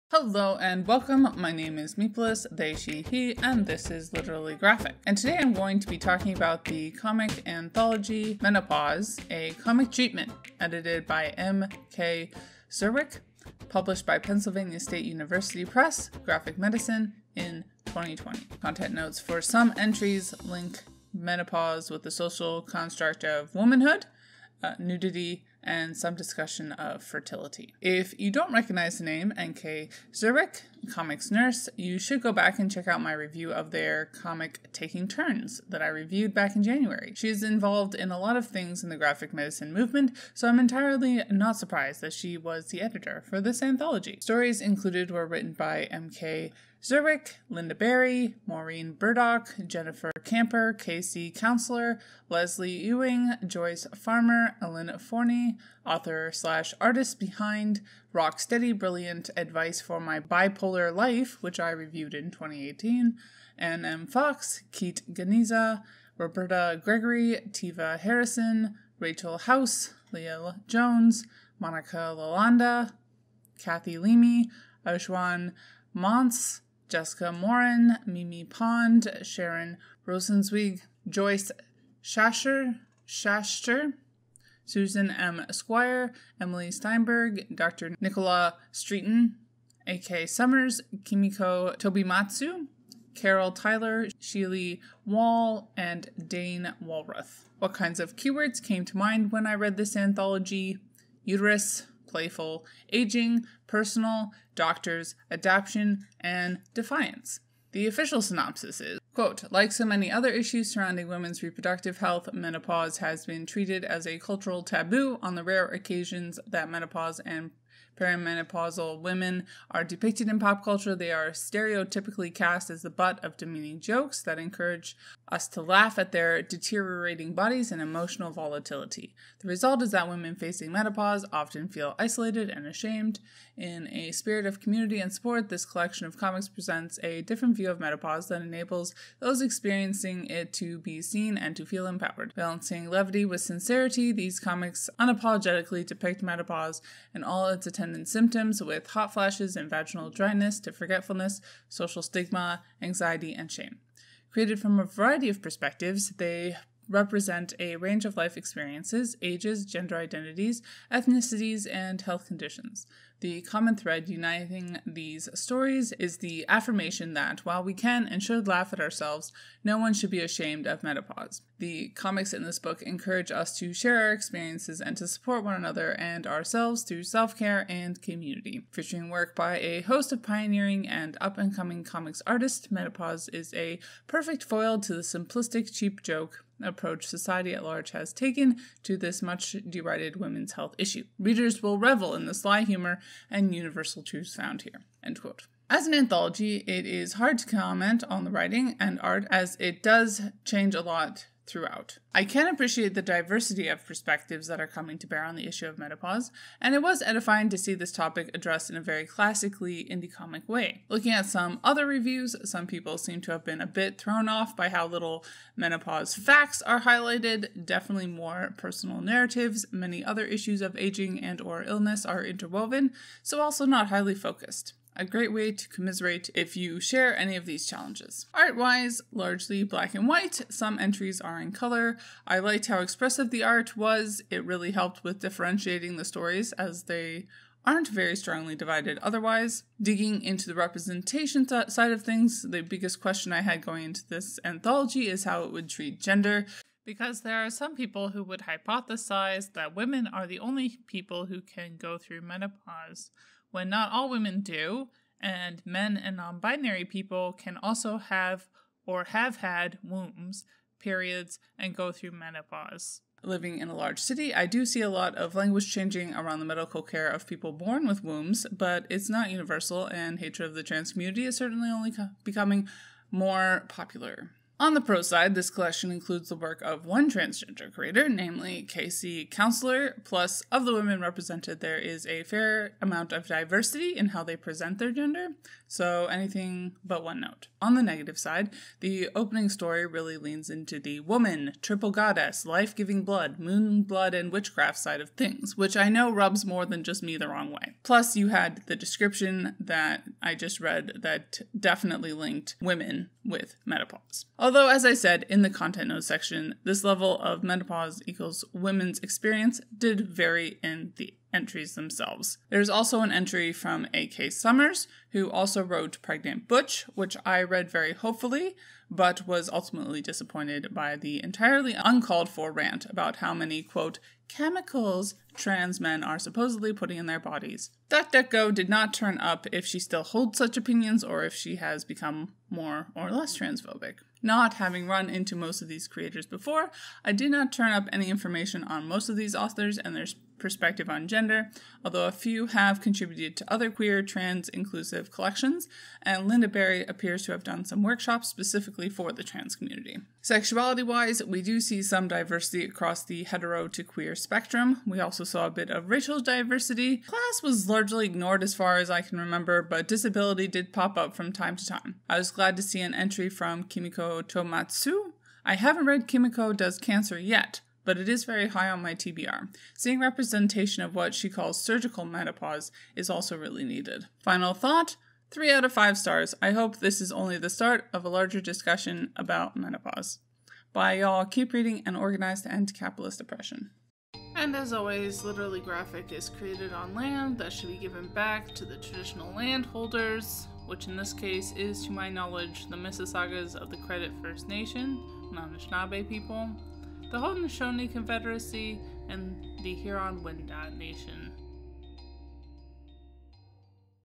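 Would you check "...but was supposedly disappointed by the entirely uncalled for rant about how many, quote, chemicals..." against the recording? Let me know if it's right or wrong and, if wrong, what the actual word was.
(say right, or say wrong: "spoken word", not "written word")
wrong: "ultimately", not "supposedly".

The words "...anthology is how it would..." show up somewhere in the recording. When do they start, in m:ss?
4:04.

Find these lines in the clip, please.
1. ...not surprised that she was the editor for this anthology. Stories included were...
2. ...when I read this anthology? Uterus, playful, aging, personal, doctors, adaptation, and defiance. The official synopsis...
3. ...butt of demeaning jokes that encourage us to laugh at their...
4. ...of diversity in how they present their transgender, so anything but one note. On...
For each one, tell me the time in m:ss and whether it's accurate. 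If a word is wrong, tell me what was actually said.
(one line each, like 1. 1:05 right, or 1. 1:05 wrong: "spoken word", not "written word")
1. 0:41 right
2. 1:39 right
3. 2:02 right
4. 4:43 wrong: "gender", not "transgender".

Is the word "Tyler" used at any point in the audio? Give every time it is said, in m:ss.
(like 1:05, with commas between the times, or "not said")
1:33.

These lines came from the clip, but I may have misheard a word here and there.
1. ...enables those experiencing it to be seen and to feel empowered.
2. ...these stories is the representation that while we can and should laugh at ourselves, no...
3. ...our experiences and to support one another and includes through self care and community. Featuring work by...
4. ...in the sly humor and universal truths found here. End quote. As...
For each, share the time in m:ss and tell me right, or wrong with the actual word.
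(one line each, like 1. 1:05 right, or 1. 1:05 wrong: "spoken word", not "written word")
1. 2:18 right
2. 2:44 wrong: "affirmation", not "representation"
3. 2:54 wrong: "ourselves", not "includes"
4. 3:12 right.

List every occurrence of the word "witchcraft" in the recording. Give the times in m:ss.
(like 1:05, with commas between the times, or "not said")
4:54.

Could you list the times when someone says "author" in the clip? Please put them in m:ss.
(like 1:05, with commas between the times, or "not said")
0:55, 5:39.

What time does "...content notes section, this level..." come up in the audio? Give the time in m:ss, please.
5:05.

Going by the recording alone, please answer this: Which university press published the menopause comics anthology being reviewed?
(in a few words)
Pennsylvania State University Press.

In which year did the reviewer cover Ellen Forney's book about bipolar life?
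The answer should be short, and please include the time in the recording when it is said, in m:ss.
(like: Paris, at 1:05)
2018, at 1:02.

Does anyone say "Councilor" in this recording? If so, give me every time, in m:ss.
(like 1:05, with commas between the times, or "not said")
0:51, 4:39.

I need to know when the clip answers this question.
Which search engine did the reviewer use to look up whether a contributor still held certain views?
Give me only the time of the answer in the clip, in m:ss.
5:28.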